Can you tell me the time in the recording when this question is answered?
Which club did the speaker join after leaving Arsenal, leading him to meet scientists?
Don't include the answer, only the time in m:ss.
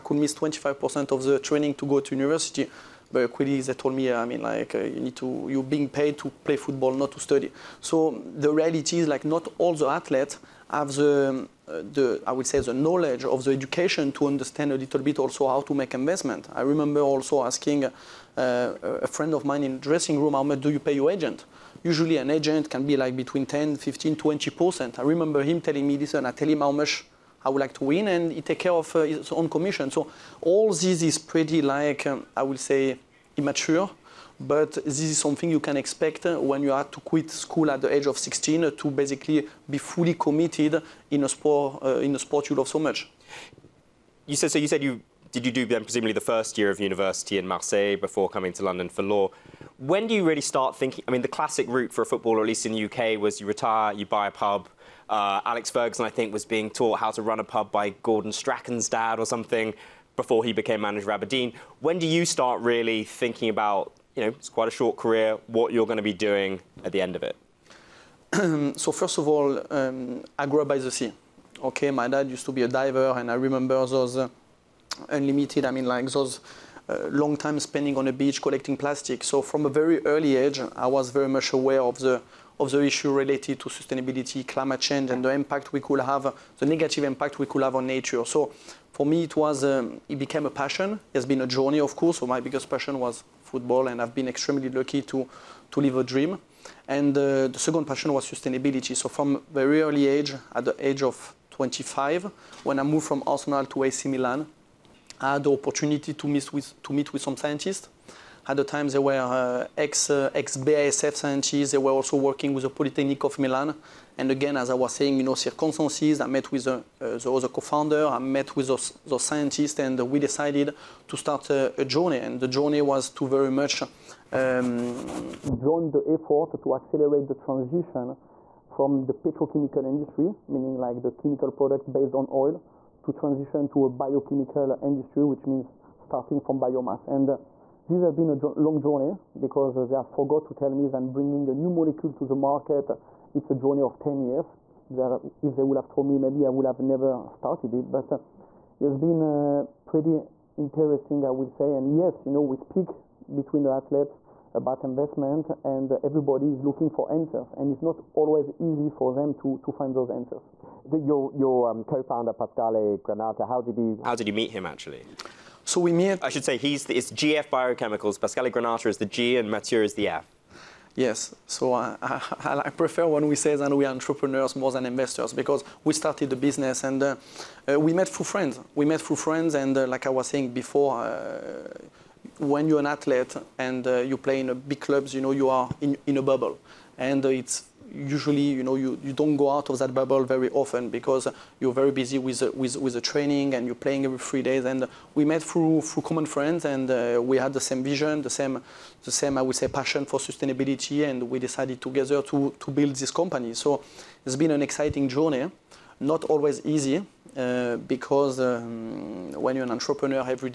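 1:43.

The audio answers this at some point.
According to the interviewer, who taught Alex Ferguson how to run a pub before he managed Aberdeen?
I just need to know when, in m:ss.
0:58.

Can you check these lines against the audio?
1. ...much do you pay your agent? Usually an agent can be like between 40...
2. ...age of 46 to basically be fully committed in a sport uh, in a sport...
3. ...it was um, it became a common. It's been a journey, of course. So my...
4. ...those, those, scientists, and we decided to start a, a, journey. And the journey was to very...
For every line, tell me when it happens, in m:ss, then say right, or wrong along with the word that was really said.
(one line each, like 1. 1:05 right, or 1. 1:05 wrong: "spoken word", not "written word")
1. 0:20 wrong: "10", not "40"
2. 0:37 wrong: "16", not "46"
3. 1:29 wrong: "passion", not "common"
4. 1:58 right.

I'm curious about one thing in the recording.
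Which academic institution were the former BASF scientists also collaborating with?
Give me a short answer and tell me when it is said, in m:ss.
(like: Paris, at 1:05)
Polytechnic of Milan, at 1:52.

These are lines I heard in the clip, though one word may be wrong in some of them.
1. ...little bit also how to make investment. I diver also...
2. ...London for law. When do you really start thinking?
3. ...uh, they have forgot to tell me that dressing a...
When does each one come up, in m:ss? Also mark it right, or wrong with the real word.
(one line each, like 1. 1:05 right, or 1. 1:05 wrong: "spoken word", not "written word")
1. 0:14 wrong: "remember", not "diver"
2. 0:48 right
3. 2:19 wrong: "bringing", not "dressing".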